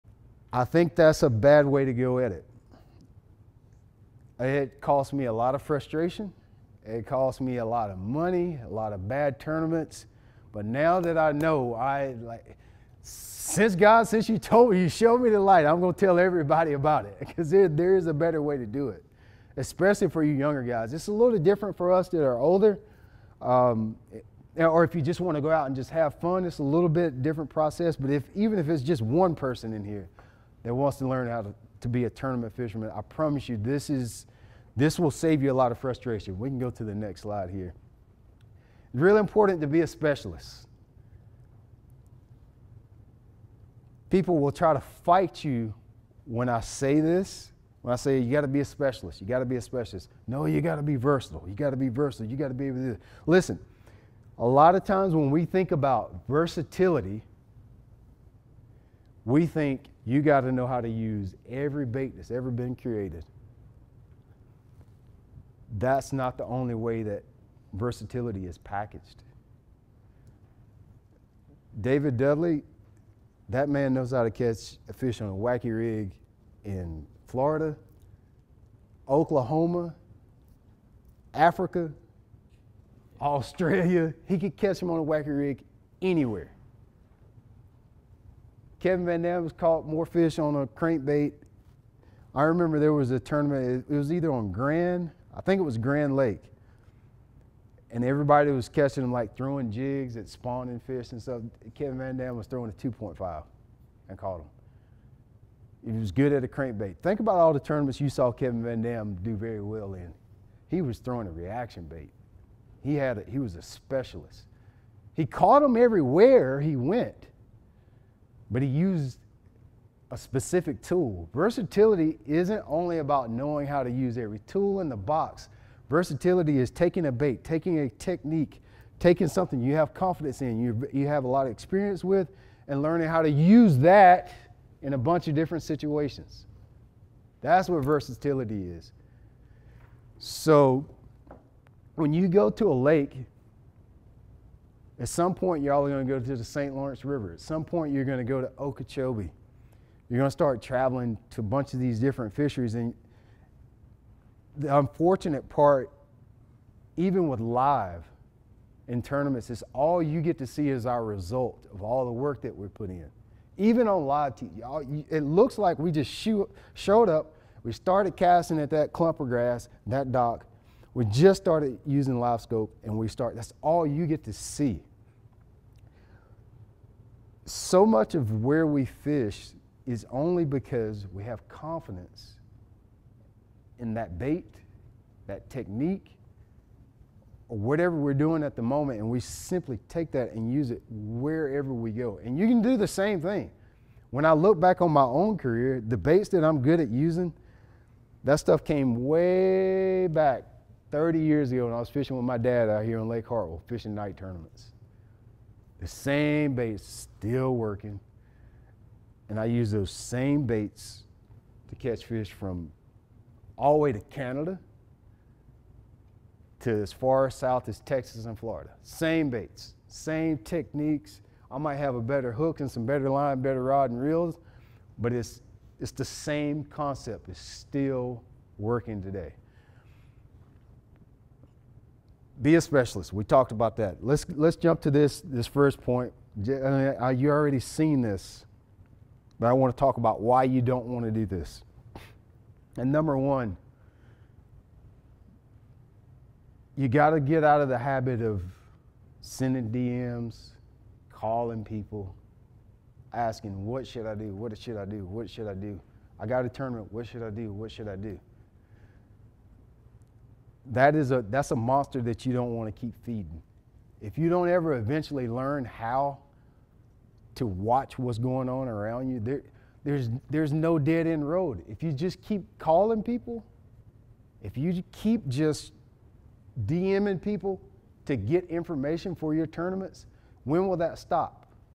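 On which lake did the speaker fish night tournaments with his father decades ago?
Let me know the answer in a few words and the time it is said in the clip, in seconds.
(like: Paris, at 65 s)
Lake Hartwell, at 203 s.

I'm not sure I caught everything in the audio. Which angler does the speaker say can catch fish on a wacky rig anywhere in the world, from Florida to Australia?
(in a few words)
David Dudley.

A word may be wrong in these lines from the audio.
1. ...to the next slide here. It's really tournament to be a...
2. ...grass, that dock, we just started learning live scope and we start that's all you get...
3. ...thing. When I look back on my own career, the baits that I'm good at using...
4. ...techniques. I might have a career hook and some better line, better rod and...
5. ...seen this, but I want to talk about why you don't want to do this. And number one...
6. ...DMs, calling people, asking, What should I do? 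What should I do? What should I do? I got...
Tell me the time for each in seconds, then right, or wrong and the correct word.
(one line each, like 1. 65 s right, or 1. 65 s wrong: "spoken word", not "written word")
1. 36 s wrong: "important", not "tournament"
2. 169 s wrong: "using", not "learning"
3. 193 s right
4. 220 s wrong: "better", not "career"
5. 237 s right
6. 249 s right.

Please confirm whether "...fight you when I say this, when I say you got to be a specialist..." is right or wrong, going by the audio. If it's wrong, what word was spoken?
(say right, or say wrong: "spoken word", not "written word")
right.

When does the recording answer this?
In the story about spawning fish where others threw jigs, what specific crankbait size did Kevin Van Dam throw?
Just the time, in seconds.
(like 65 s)
102 s.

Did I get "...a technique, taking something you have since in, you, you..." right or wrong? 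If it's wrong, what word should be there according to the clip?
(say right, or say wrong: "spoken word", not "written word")
wrong: "confidence", not "since".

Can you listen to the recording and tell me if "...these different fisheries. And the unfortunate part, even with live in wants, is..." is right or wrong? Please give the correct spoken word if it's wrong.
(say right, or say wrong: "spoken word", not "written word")
wrong: "tournaments", not "wants".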